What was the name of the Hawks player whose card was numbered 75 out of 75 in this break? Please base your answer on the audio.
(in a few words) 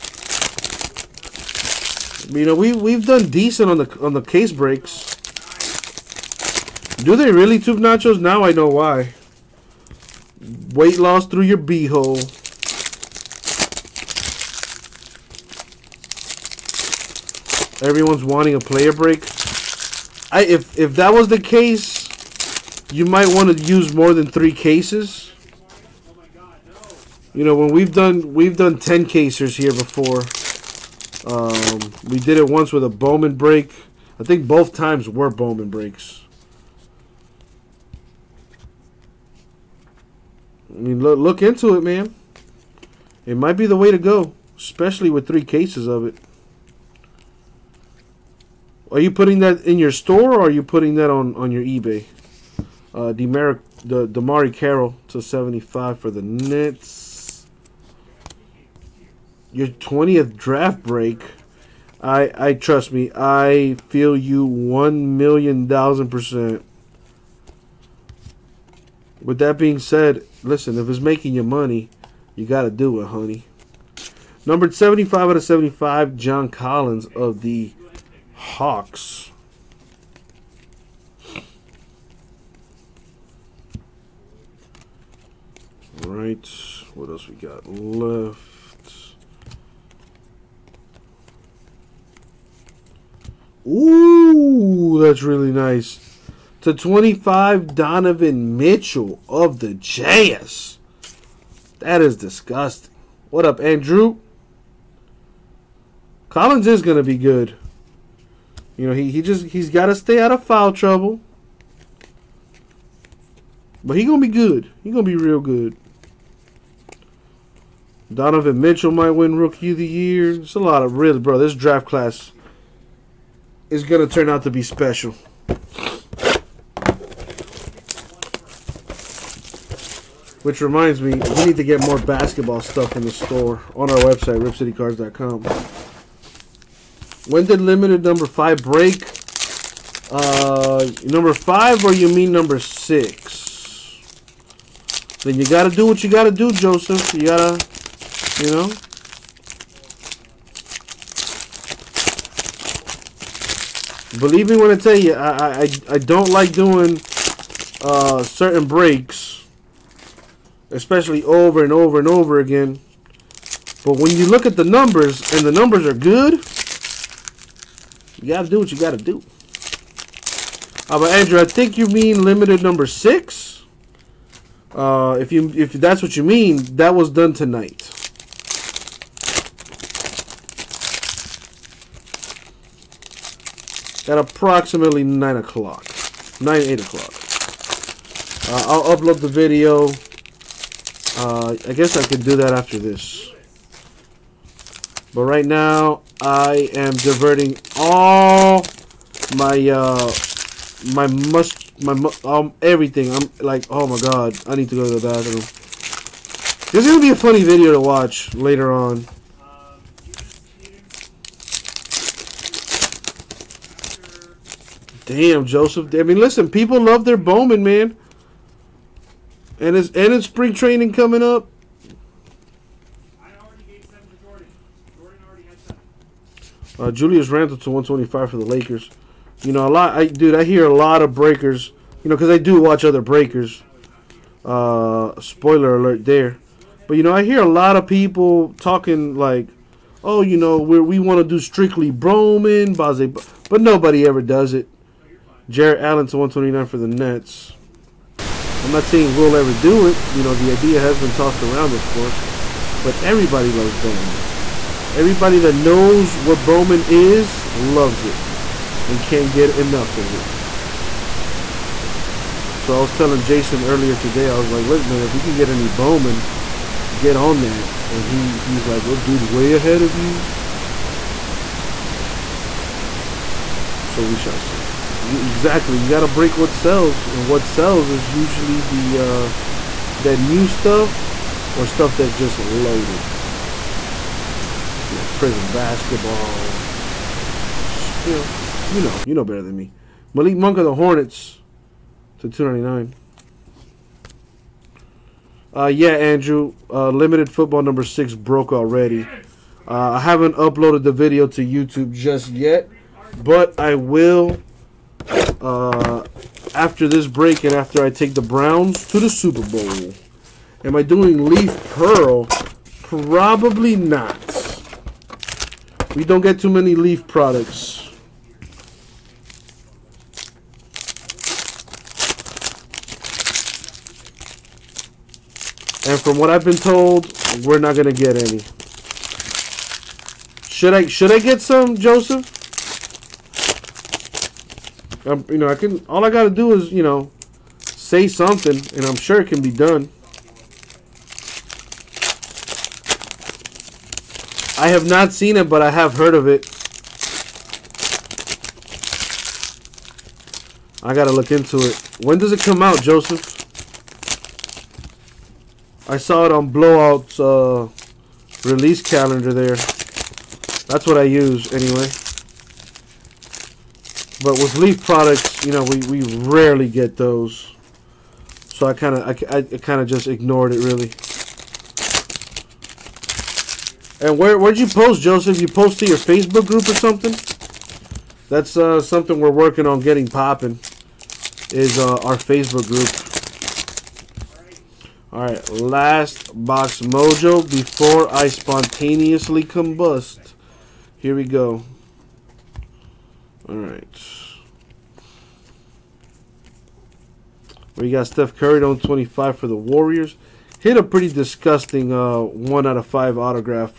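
John Collins.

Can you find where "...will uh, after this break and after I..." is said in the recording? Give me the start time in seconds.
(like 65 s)
303 s.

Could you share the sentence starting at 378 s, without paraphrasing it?
That's uh, something we're working on getting popping is uh, our Facebook group.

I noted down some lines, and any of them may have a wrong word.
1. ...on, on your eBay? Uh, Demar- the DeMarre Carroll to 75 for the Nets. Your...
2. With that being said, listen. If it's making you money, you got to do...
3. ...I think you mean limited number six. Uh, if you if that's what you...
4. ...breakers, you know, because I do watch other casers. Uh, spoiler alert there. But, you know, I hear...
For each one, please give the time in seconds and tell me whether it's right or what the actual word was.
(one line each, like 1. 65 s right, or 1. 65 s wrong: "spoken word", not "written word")
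1. 51 s right
2. 69 s right
3. 171 s right
4. 231 s wrong: "breakers", not "casers".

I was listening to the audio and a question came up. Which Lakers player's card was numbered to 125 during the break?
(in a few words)
Julius Randle.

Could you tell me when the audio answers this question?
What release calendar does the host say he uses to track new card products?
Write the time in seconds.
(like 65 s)
356 s.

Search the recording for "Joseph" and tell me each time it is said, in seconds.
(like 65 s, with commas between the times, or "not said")
146 s, 215 s, 331 s, 352 s, 375 s.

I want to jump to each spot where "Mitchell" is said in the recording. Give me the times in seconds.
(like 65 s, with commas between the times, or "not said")
98 s, 118 s.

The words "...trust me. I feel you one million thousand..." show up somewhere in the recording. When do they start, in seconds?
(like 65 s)
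62 s.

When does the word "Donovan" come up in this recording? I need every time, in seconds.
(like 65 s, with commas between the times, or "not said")
97 s, 118 s.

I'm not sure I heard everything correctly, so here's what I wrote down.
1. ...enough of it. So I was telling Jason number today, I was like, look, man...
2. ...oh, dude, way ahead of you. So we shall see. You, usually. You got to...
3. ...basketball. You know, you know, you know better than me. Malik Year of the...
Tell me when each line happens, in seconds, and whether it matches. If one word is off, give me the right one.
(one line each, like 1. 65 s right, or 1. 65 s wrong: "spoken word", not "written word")
1. 259 s wrong: "earlier", not "number"
2. 268 s wrong: "exactly", not "usually"
3. 285 s wrong: "Monk", not "Year".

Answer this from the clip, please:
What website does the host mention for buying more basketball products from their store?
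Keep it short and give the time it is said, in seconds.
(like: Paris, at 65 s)
ripcitycards.com, at 134 s.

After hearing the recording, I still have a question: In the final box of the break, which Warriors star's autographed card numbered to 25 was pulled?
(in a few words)
Steph Curry.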